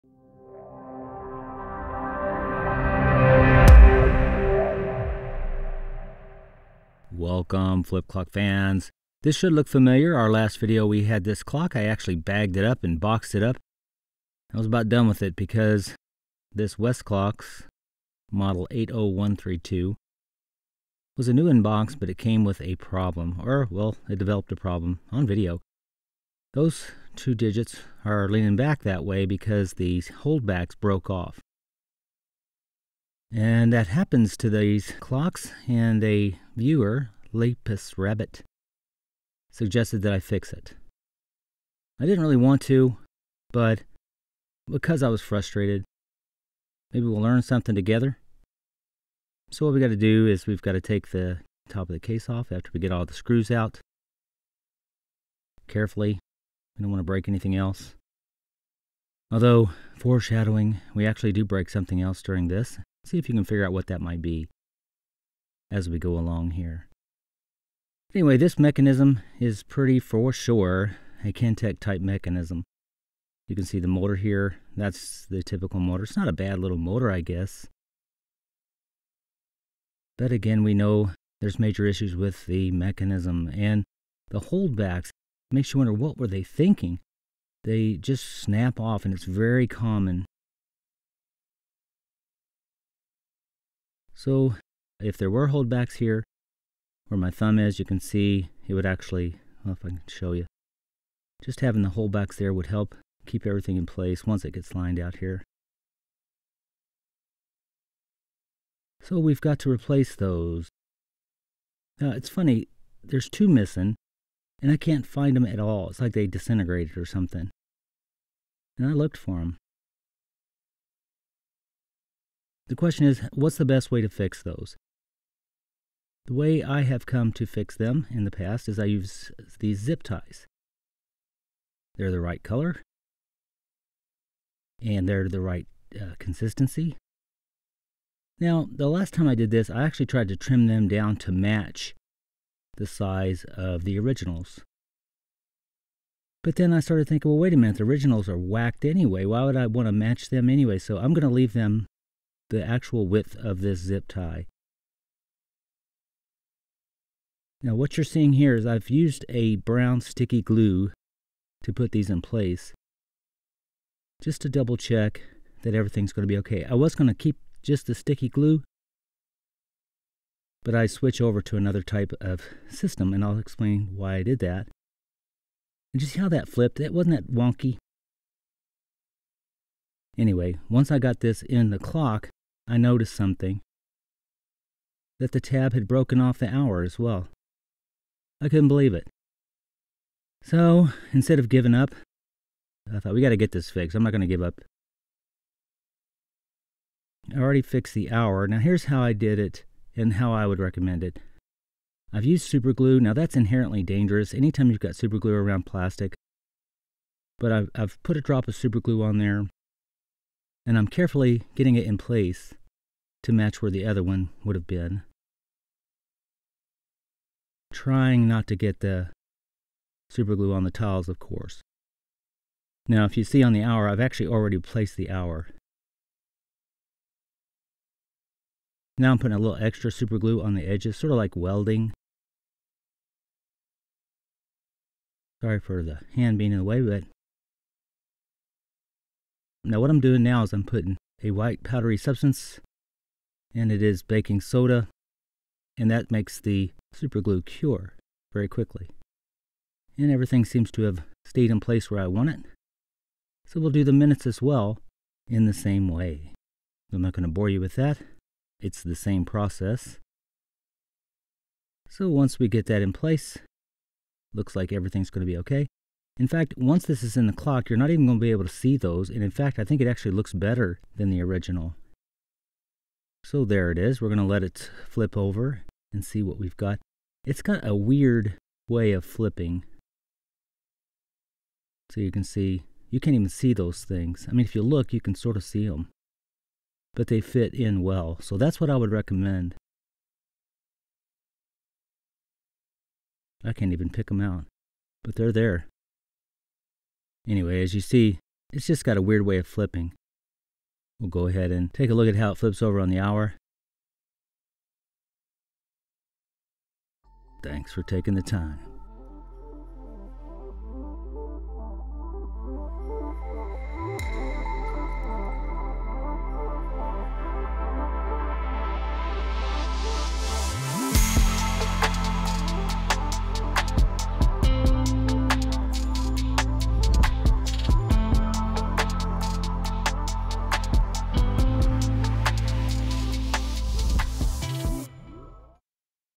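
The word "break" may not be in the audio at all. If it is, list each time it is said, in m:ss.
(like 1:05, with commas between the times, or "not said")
0:57, 1:01.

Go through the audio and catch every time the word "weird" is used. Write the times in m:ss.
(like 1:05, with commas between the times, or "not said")
4:37, 4:59.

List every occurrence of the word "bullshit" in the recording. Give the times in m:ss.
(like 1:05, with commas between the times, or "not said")
not said.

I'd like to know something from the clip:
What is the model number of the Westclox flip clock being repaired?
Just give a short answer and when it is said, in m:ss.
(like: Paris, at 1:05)
80132, at 0:18.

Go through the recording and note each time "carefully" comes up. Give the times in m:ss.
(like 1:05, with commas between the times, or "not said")
0:55, 3:30.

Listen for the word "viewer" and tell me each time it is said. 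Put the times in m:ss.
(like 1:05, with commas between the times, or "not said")
0:36.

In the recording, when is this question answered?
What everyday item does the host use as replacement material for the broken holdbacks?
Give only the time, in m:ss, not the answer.
2:09.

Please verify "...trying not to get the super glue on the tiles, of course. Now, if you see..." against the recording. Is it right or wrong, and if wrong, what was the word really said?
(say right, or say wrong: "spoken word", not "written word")
right.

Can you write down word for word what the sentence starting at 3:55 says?
Sorry for the hand being in the way, but...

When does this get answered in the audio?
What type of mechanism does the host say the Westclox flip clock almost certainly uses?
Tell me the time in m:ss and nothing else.
1:11.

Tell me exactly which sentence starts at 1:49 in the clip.
So we've got to replace those.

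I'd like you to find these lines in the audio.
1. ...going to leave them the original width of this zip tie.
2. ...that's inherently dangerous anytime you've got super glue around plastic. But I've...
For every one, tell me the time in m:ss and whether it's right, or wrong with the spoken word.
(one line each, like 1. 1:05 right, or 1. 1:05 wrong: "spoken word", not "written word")
1. 2:31 wrong: "actual", not "original"
2. 3:23 right.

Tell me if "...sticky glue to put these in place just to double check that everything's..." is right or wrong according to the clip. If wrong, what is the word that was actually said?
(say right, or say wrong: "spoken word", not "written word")
right.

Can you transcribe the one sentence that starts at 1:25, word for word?
Makes you wonder what were they thinking?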